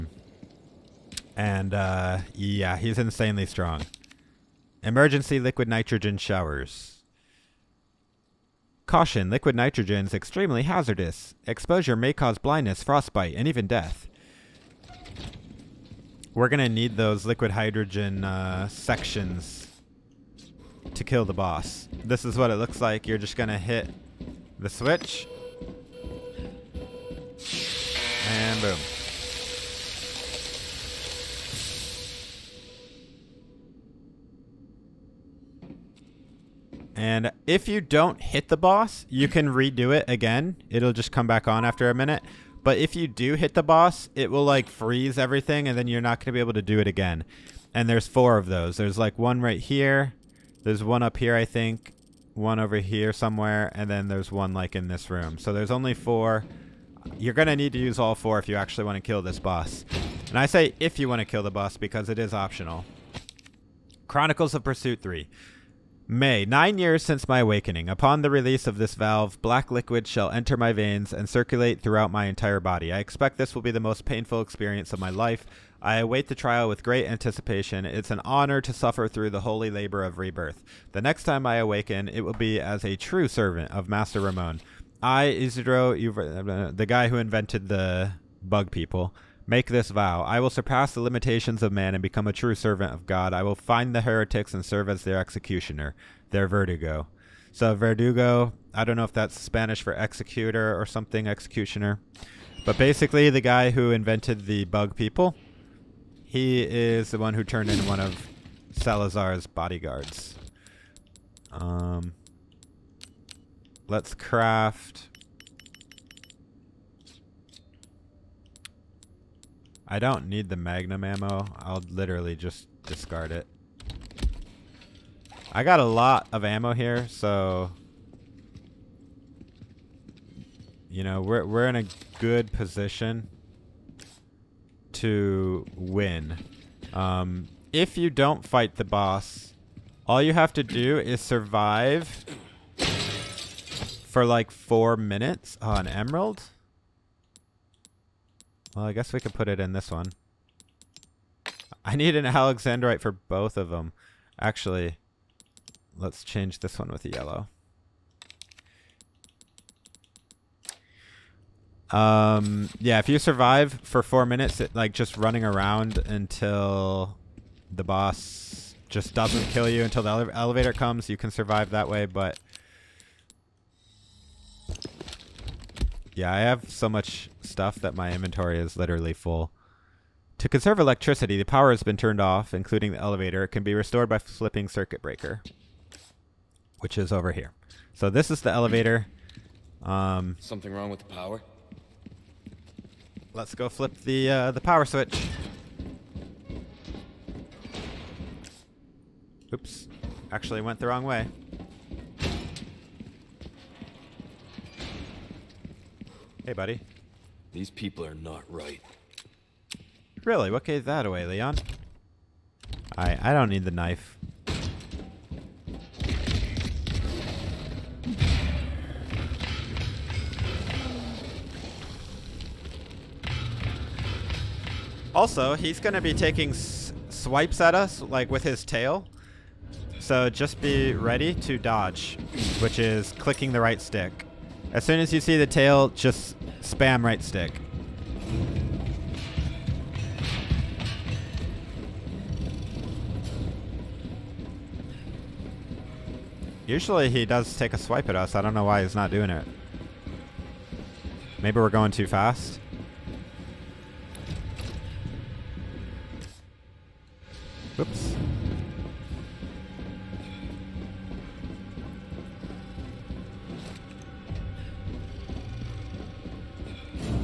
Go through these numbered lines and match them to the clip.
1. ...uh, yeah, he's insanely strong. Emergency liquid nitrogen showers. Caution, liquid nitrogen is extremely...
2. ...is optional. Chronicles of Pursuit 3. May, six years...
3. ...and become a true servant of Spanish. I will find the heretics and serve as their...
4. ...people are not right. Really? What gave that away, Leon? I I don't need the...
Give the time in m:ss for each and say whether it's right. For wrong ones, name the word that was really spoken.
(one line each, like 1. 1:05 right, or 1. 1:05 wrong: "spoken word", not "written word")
1. 0:01 right
2. 1:02 wrong: "nine", not "six"
3. 1:31 wrong: "God", not "Spanish"
4. 3:27 right.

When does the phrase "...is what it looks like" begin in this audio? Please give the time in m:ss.
0:22.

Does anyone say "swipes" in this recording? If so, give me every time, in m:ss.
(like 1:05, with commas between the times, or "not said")
3:46, 4:07.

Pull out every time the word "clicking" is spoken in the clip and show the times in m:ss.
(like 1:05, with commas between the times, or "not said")
3:53.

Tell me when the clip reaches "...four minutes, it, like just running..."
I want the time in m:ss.
2:44.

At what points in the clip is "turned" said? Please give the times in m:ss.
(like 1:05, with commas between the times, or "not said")
1:47, 3:01.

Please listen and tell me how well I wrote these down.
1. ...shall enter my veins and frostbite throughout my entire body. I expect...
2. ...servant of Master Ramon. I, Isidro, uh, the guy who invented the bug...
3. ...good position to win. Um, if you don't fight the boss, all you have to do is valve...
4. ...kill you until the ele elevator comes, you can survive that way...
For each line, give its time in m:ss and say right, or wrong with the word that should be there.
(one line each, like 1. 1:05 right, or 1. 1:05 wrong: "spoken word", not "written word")
1. 1:10 wrong: "circulate", not "frostbite"
2. 1:23 right
3. 2:12 wrong: "survive", not "valve"
4. 2:49 right.